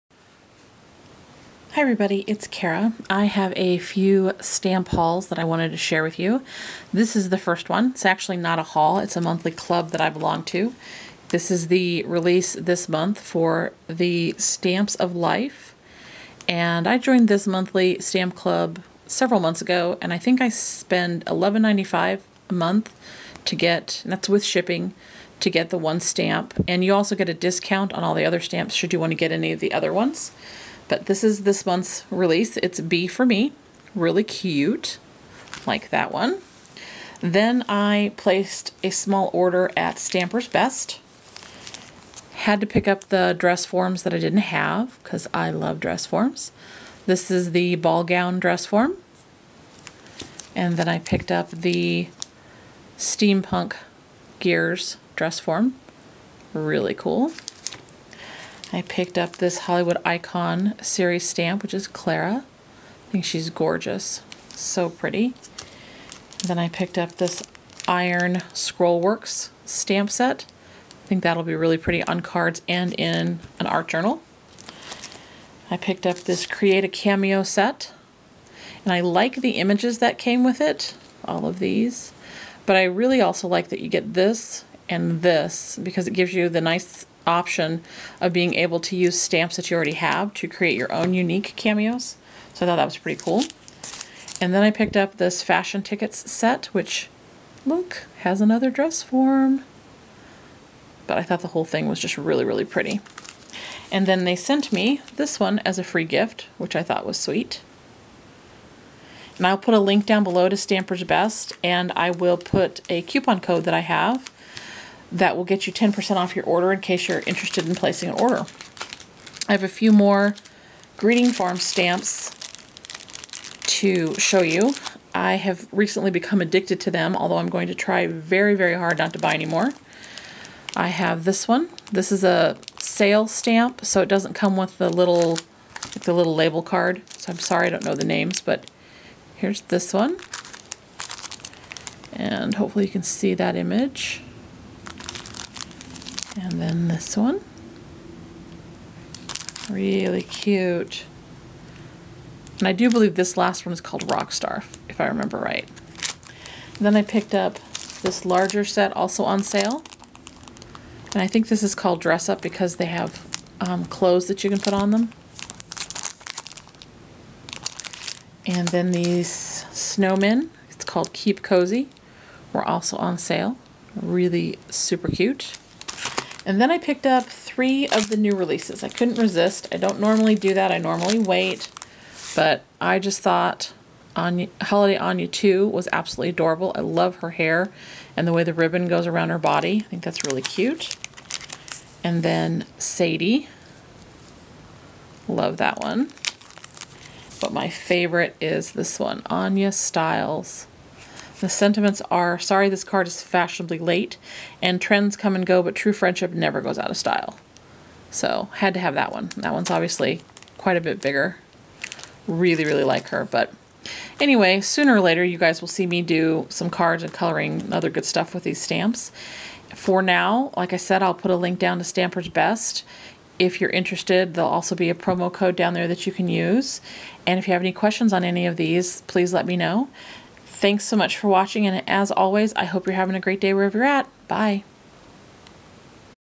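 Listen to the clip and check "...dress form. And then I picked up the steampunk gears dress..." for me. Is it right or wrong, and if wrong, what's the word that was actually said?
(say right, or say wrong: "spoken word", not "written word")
right.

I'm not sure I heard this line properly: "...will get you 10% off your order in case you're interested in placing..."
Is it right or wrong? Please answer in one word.
right.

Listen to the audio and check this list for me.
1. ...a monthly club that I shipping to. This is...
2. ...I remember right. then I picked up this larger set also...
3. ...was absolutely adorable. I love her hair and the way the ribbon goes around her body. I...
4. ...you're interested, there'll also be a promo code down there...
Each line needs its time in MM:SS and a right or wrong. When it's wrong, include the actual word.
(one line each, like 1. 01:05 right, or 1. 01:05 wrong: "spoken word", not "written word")
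1. 00:09 wrong: "belong", not "shipping"
2. 02:35 right
3. 03:05 right
4. 03:43 right.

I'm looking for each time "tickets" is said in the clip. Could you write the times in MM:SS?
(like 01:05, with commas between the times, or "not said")
01:35.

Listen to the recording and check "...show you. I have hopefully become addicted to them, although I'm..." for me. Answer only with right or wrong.
wrong.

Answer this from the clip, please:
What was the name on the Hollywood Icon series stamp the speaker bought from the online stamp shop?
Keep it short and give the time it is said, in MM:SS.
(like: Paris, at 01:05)
Clara, at 01:01.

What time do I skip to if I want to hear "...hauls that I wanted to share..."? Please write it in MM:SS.
00:04.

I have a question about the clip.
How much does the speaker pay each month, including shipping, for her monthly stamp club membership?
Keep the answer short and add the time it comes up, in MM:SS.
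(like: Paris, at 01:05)
$11.95, at 00:21.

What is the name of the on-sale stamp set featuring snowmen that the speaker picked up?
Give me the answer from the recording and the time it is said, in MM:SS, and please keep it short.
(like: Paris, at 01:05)
Keep Cozy, at 02:51.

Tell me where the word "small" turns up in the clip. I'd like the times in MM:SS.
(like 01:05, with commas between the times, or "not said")
00:38.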